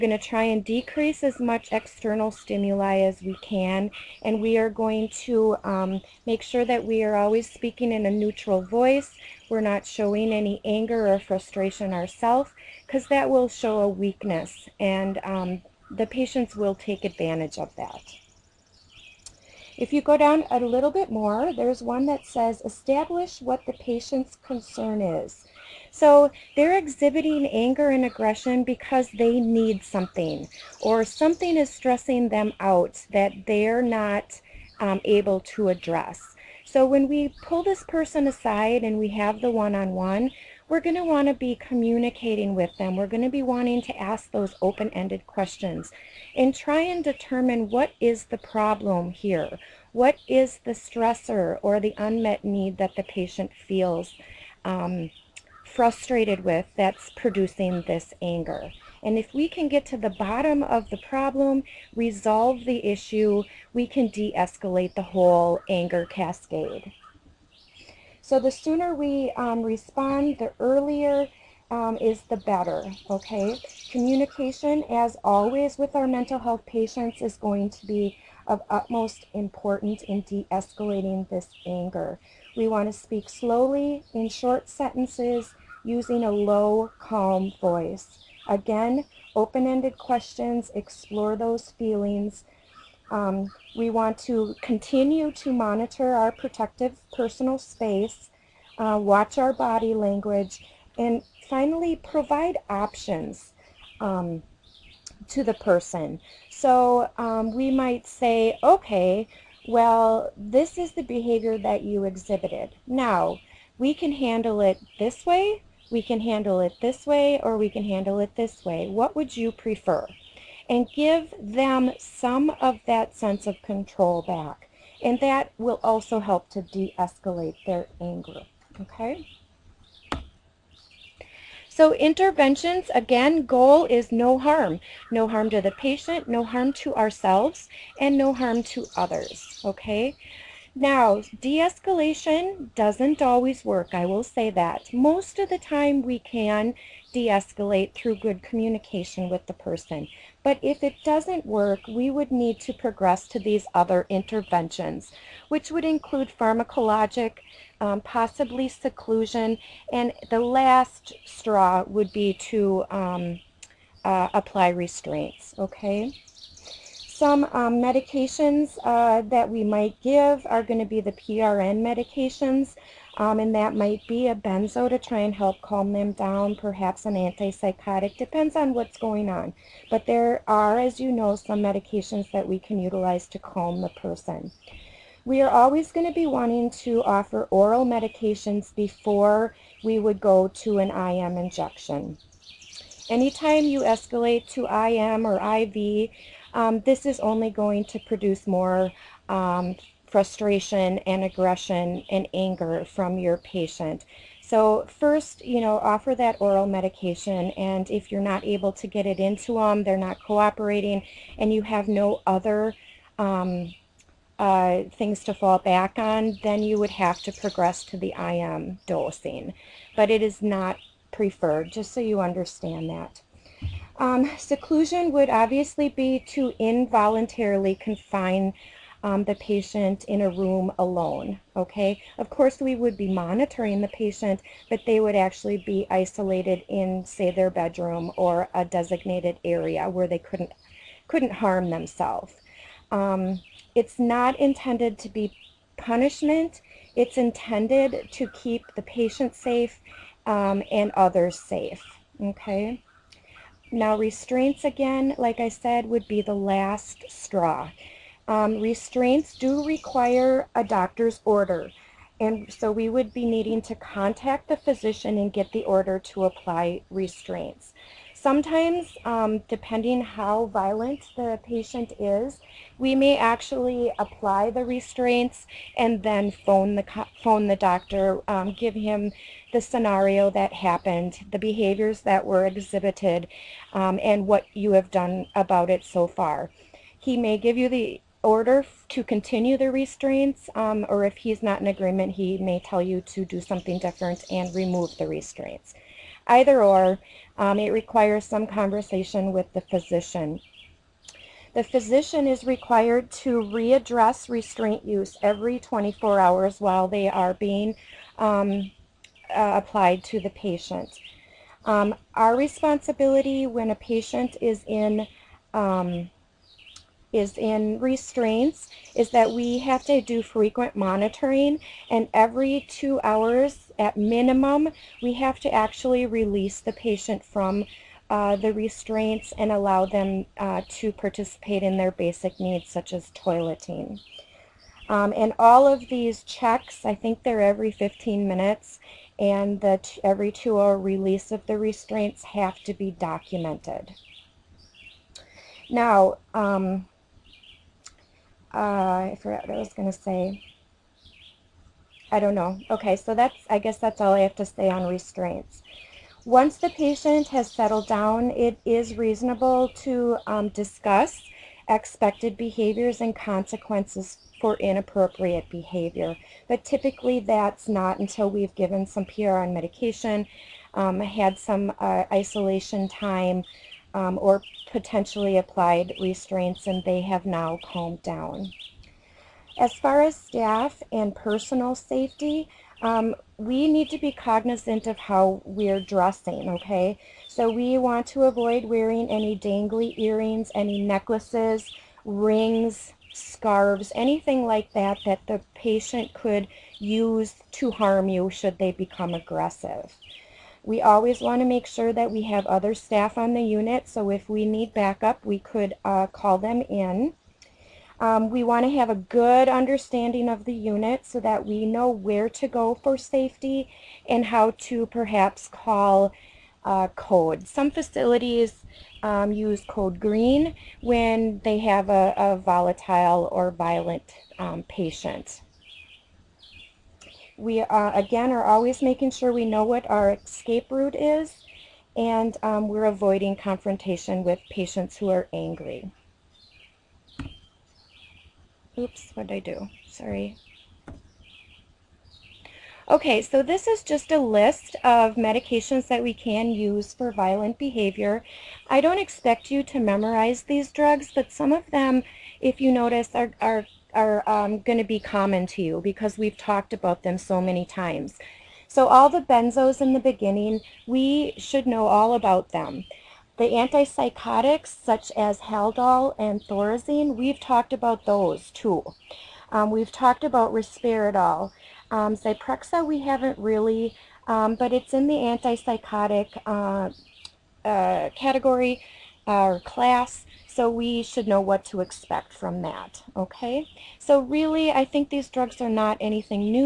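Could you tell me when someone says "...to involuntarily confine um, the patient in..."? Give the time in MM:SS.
03:46.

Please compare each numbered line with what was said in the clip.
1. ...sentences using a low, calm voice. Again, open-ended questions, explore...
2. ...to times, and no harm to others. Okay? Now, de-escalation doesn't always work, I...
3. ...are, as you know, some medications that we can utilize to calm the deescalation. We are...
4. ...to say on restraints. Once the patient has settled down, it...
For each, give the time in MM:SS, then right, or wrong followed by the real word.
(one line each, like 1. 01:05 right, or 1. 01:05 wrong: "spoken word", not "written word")
1. 01:24 right
2. 02:16 wrong: "ourselves", not "times"
3. 03:00 wrong: "person", not "deescalation"
4. 05:54 right.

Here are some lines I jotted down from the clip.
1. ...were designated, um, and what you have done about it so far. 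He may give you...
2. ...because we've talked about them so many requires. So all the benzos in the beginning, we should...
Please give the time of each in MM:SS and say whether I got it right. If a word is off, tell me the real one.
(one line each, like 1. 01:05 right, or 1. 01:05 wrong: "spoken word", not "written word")
1. 04:42 wrong: "exhibited", not "designated"
2. 07:35 wrong: "times", not "requires".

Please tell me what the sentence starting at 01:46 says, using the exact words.
So um, we might say, okay, well, this is the behavior that you exhibited.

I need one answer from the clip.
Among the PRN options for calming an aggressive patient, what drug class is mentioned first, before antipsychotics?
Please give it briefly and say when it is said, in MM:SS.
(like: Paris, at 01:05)
a benzo, at 02:54.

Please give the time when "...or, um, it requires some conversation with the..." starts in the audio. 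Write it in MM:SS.
04:56.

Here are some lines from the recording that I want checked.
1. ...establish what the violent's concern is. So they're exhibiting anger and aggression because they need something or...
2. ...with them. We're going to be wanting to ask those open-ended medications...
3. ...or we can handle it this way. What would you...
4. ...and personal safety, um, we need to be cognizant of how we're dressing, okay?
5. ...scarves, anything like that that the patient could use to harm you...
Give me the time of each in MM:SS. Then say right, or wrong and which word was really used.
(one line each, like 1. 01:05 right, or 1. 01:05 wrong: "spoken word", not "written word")
1. 00:22 wrong: "patient", not "violent"
2. 00:42 wrong: "questions", not "medications"
3. 01:57 right
4. 06:20 right
5. 06:33 right.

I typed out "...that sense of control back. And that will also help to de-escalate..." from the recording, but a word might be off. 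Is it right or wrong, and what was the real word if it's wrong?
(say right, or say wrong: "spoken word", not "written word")
right.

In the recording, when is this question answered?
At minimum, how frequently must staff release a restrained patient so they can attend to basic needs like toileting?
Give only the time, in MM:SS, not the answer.
05:22.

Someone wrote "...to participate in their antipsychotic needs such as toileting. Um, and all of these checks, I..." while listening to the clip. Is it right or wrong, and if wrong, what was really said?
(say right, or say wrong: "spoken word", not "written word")
wrong: "basic", not "antipsychotic".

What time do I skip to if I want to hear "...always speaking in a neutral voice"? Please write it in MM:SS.
00:07.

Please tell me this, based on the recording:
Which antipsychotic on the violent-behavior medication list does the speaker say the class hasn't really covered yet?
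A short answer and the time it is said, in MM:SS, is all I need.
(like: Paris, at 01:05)
Zyprexa, at 07:52.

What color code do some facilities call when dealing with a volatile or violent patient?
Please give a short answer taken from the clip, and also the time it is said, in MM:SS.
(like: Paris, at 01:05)
code green, at 06:59.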